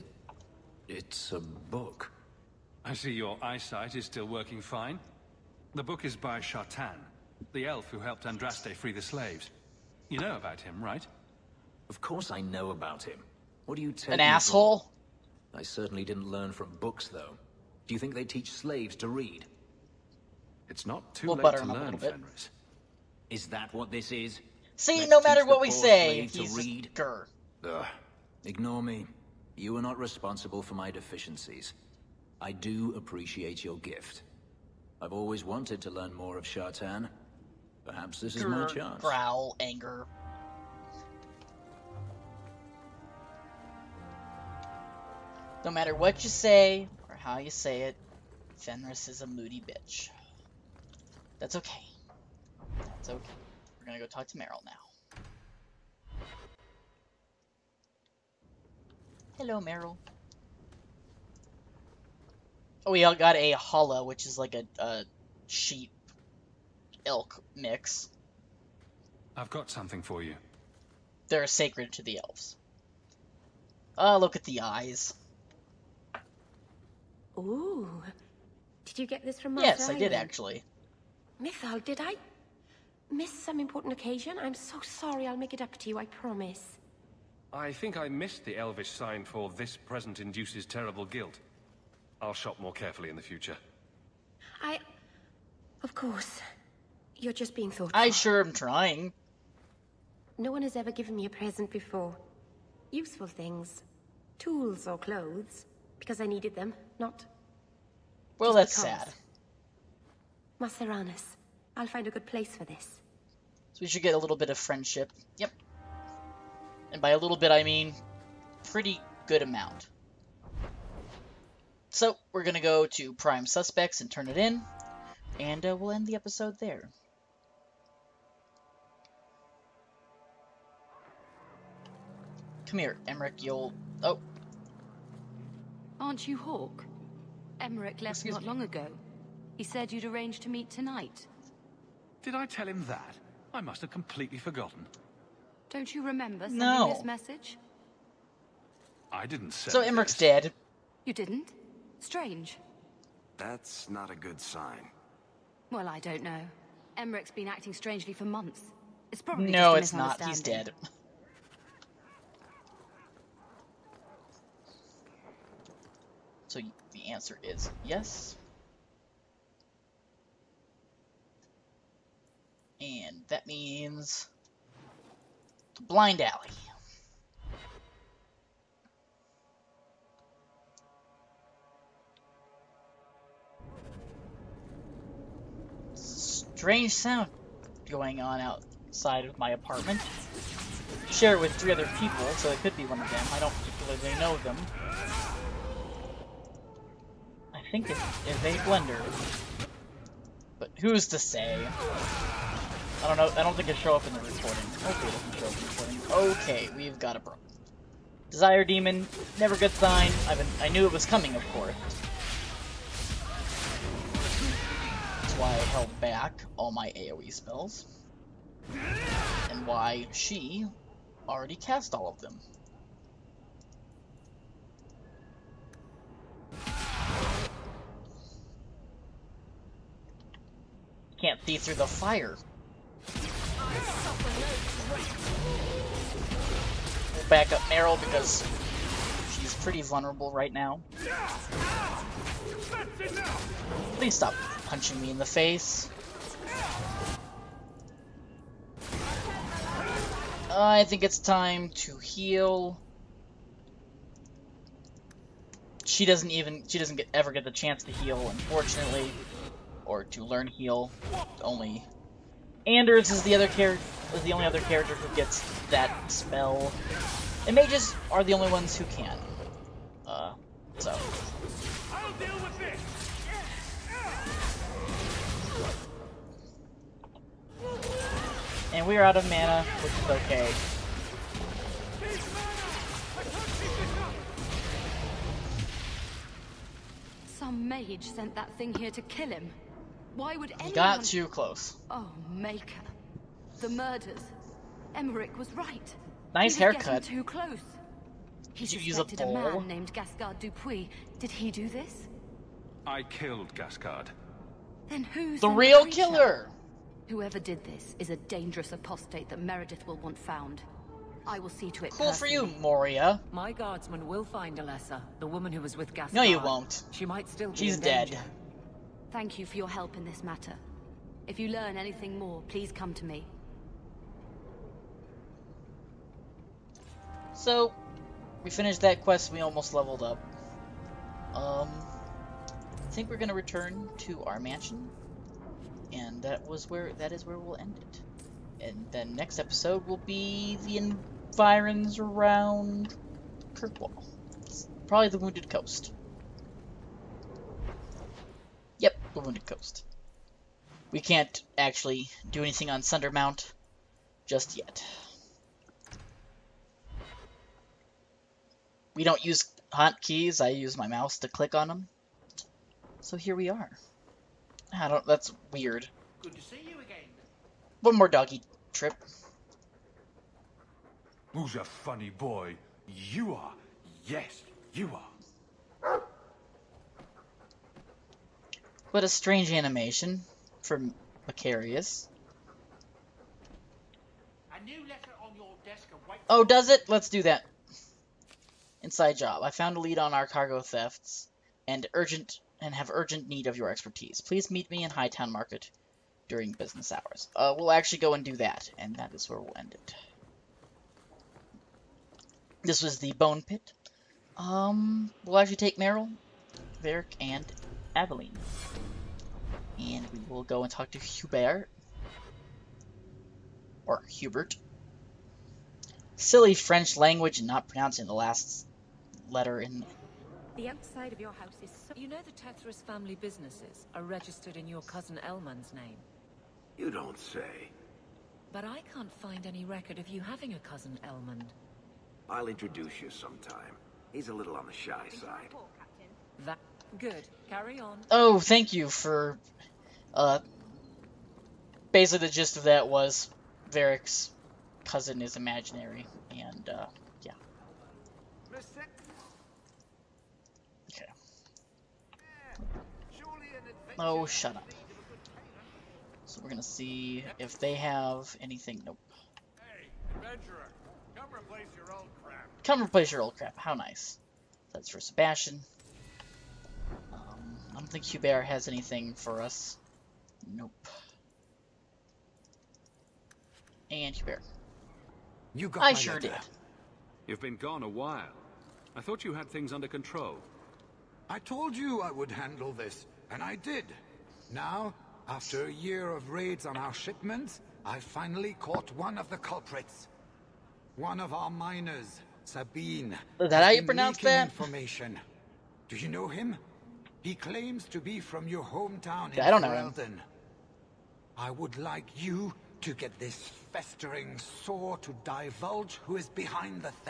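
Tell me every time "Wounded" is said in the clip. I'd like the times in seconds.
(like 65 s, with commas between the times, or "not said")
345 s, 349 s.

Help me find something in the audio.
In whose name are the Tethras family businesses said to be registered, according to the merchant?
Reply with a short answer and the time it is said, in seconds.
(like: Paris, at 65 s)
Elman, at 425 s.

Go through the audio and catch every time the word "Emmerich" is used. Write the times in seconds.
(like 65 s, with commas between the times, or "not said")
133 s, 137 s, 149 s, 156 s, 294 s.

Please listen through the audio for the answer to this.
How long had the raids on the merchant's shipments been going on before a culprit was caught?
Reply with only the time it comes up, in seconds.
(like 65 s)
485 s.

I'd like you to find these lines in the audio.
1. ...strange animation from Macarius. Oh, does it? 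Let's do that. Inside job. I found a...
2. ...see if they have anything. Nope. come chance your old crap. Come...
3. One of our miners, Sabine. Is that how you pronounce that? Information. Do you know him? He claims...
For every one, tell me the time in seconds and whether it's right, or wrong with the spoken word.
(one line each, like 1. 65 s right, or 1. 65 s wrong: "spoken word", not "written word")
1. 379 s right
2. 456 s wrong: "replace", not "chance"
3. 490 s right.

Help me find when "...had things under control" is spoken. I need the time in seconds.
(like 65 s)
479 s.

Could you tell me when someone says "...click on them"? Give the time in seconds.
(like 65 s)
361 s.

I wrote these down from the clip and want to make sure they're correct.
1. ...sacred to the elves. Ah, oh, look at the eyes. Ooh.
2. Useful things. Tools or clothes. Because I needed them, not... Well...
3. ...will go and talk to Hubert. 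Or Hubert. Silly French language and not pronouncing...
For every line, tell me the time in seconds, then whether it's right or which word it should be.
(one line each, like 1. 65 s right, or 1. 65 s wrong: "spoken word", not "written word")
1. 71 s right
2. 102 s right
3. 410 s right.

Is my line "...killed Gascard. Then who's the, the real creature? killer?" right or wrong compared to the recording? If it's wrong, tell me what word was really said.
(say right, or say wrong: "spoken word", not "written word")
right.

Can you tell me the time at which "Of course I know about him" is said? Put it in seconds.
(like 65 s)
11 s.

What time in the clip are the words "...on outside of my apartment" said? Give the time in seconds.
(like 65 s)
188 s.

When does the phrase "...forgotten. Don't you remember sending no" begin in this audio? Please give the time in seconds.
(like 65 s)
144 s.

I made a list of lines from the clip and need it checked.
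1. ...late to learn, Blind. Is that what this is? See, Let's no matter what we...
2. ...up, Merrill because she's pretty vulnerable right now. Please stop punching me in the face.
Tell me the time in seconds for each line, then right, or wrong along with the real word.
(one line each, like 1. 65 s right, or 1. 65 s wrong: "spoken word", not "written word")
1. 21 s wrong: "Fenris", not "Blind"
2. 237 s right.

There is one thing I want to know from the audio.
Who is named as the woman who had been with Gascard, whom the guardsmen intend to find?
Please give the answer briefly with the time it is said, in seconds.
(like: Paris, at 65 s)
Alessa, at 314 s.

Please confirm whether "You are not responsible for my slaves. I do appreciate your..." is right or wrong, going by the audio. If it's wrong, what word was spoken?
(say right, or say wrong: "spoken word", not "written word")
wrong: "deficiencies", not "slaves".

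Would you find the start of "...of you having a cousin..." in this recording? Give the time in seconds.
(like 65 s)
429 s.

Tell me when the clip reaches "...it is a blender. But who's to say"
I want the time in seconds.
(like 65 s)
197 s.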